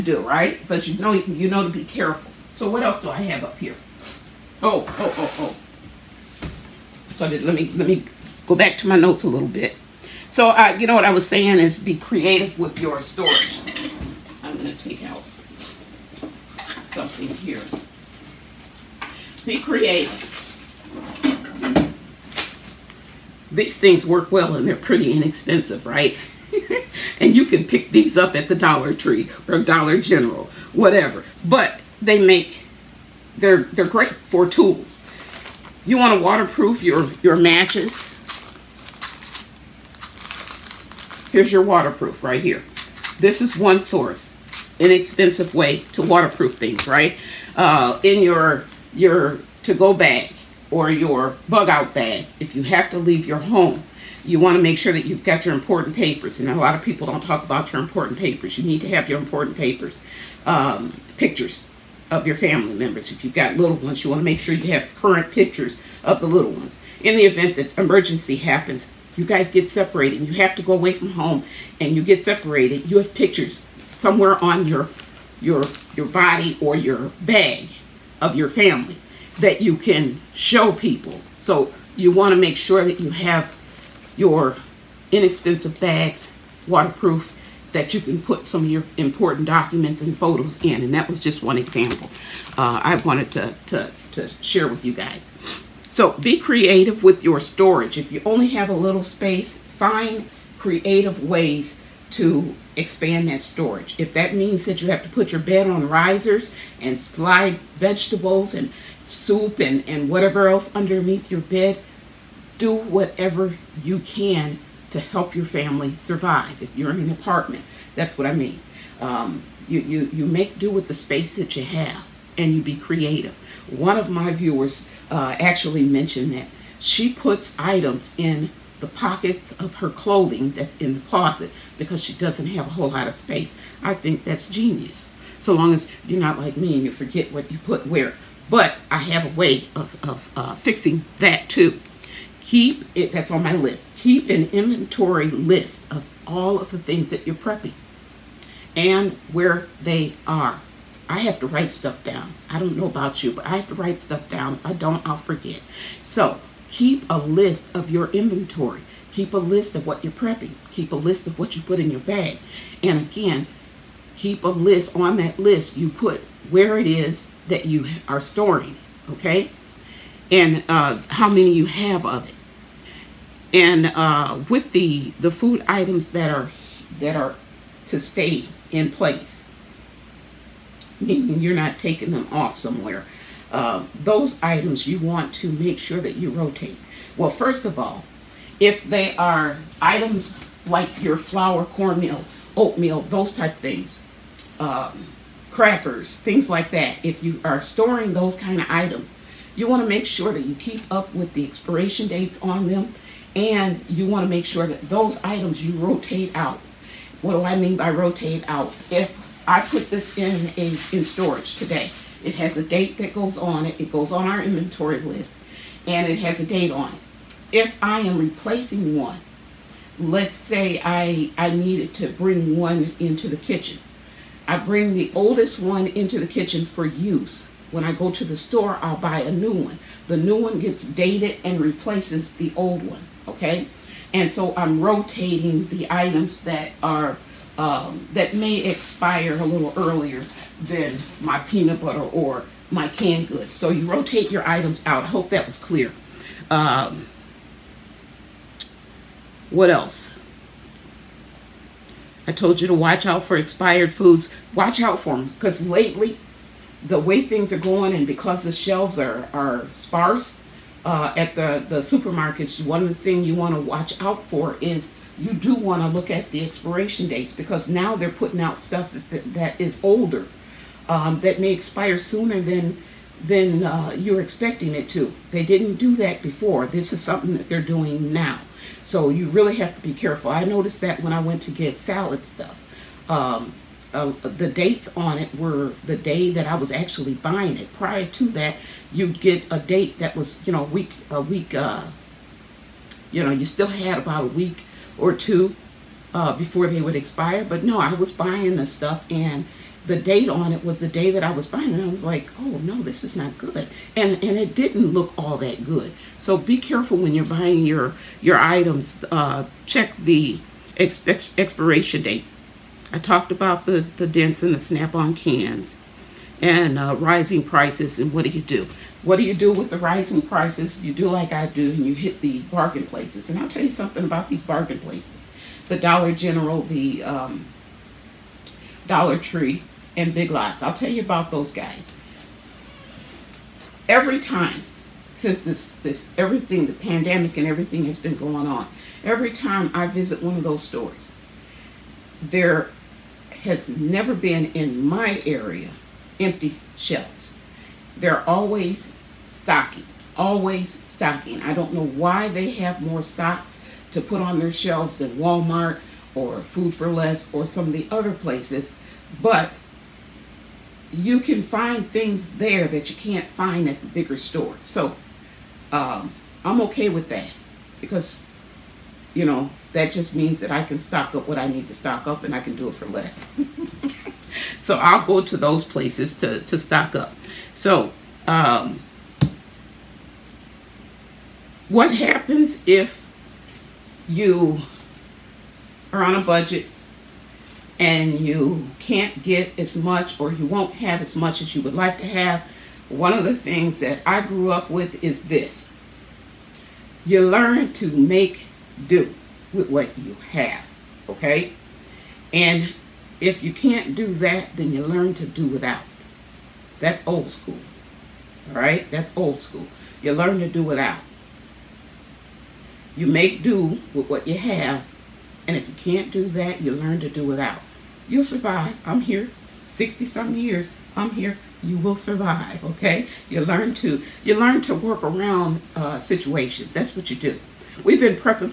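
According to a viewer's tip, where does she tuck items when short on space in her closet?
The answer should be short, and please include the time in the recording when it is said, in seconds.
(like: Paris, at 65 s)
pockets of her clothing, at 128 s.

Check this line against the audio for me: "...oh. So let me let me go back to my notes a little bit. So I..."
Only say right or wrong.
right.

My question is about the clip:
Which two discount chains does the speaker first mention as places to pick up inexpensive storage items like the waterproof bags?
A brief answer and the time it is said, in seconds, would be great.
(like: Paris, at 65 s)
Dollar Tree or Dollar General, at 28 s.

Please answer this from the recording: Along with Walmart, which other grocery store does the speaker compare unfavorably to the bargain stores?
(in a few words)
Food for Less.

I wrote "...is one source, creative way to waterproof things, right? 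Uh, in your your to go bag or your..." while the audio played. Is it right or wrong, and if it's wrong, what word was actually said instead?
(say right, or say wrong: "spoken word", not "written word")
wrong: "inexpensive", not "creative".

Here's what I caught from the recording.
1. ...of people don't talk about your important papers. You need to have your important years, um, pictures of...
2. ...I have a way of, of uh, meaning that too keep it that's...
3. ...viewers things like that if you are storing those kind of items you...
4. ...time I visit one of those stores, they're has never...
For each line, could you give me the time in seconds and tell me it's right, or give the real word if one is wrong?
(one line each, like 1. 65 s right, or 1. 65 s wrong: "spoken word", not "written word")
1. 56 s wrong: "papers", not "years"
2. 138 s wrong: "fixing", not "meaning"
3. 195 s wrong: "crackers", not "viewers"
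4. 339 s right.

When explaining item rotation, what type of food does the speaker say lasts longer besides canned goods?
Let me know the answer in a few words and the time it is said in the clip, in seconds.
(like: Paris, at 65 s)
peanut butter, at 241 s.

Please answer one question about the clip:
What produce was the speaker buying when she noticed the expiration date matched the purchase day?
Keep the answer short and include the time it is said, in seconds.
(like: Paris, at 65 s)
salad stuff, at 281 s.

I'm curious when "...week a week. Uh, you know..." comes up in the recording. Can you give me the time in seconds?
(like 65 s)
290 s.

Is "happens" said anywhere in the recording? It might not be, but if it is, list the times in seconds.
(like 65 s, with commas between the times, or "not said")
68 s, 381 s.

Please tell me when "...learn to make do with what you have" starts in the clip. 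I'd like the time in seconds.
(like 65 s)
397 s.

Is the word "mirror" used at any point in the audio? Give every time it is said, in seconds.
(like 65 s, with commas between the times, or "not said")
not said.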